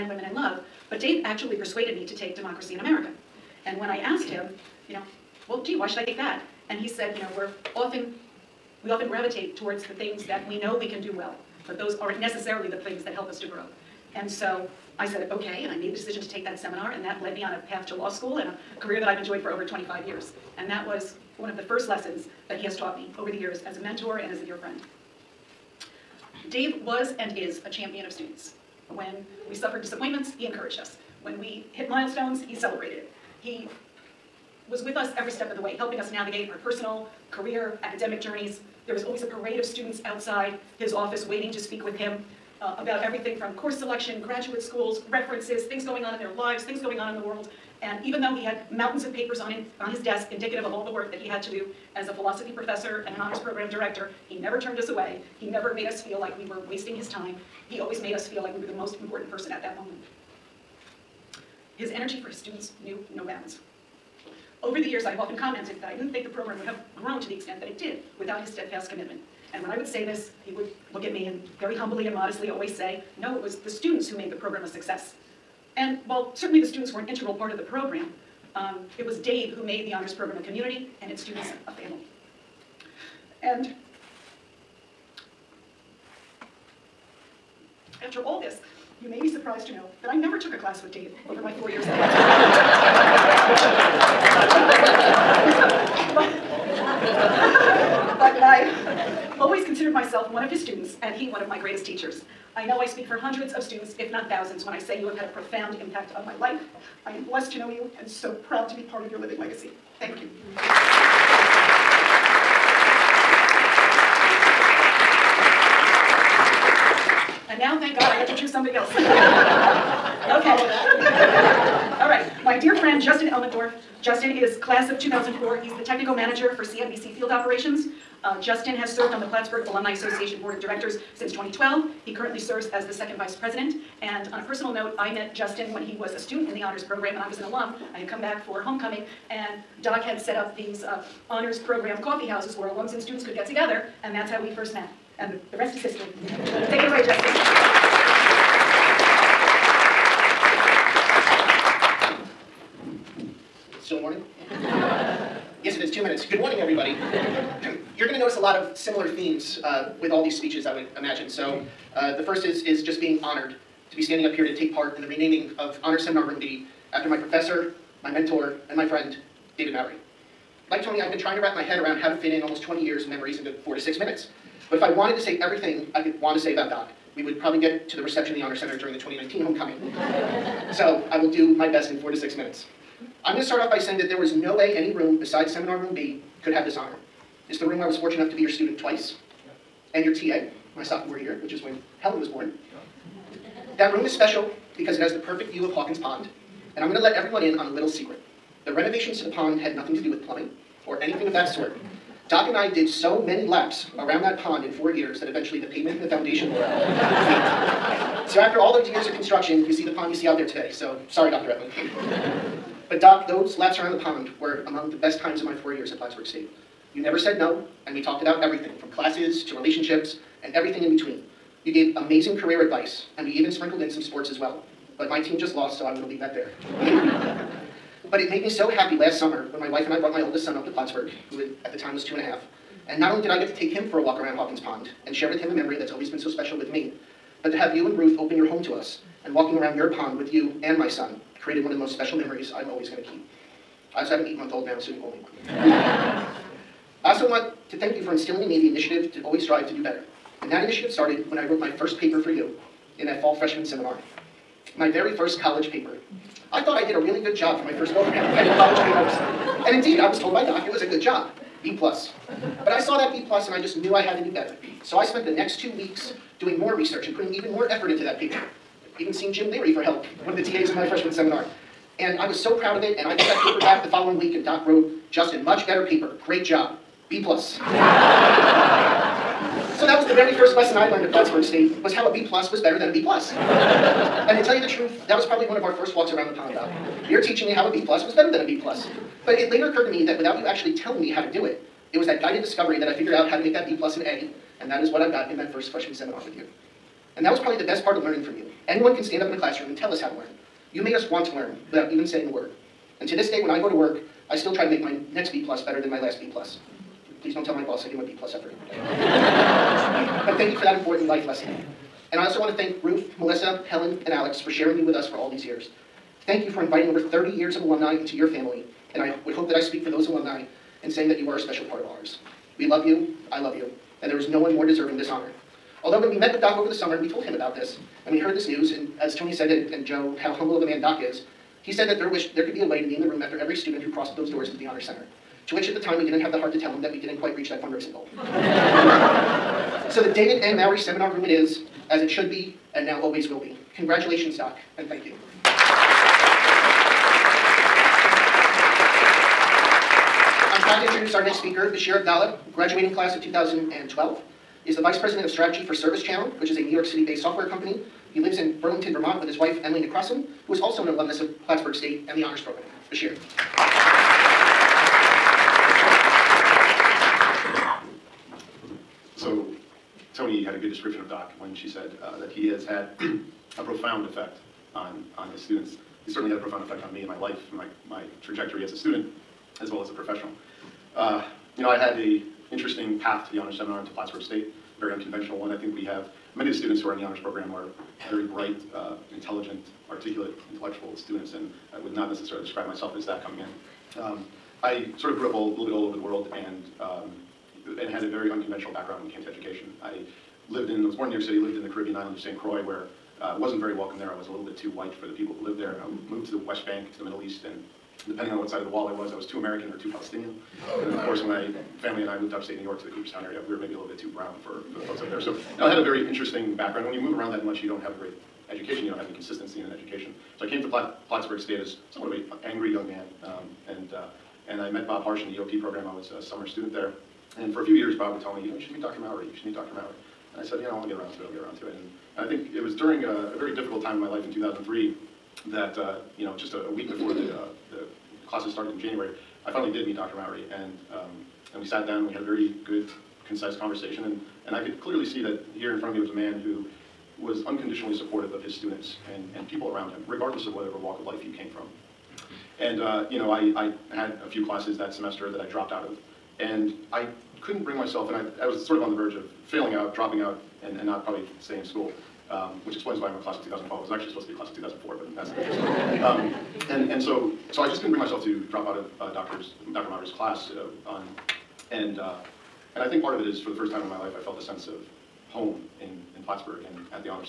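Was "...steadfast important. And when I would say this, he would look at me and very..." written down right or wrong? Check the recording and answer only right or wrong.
wrong.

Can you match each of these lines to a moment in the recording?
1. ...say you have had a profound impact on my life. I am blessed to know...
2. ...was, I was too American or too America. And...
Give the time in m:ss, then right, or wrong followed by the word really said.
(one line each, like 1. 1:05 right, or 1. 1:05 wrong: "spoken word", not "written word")
1. 1:44 right
2. 6:48 wrong: "Palestinian", not "America".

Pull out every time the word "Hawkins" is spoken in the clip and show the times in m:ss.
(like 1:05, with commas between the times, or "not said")
3:15, 3:54.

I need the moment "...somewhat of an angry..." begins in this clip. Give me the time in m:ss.
7:01.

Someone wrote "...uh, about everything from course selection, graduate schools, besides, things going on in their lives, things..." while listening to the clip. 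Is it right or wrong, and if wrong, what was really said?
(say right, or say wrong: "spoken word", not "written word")
wrong: "references", not "besides".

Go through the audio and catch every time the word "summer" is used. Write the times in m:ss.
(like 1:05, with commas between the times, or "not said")
3:49, 5:26, 7:06.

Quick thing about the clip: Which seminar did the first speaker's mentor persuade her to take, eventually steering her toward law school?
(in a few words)
Democracy in America.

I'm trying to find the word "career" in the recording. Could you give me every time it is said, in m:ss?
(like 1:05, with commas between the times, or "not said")
0:18, 0:37, 3:42.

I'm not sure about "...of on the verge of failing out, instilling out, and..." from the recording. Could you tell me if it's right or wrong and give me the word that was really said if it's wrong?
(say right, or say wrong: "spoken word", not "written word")
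wrong: "dropping", not "instilling".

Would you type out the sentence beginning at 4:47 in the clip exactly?
You're teaching me how a B plus was better than a B plus.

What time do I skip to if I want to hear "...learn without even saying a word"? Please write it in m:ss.
5:01.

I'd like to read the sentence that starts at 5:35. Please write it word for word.
To which at the time we didn't have the heart to tell him that we didn't quite reach that fundraising goal.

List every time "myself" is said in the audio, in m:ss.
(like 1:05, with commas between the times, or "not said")
1:39, 6:32, 7:37, 7:47.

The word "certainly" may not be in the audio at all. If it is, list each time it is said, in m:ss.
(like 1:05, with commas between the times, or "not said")
1:16, 6:16.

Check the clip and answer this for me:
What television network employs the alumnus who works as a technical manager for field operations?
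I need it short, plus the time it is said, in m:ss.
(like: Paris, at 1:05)
CNBC, at 2:06.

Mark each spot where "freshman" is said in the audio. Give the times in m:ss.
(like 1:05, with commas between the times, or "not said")
4:13, 4:30, 4:55.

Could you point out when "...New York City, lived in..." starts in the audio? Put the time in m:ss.
6:41.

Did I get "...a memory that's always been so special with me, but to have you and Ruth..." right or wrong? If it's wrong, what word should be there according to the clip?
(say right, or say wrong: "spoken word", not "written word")
right.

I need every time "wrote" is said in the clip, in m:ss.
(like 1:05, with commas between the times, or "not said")
4:11, 4:34.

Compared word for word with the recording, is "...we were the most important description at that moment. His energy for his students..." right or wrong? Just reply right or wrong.
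wrong.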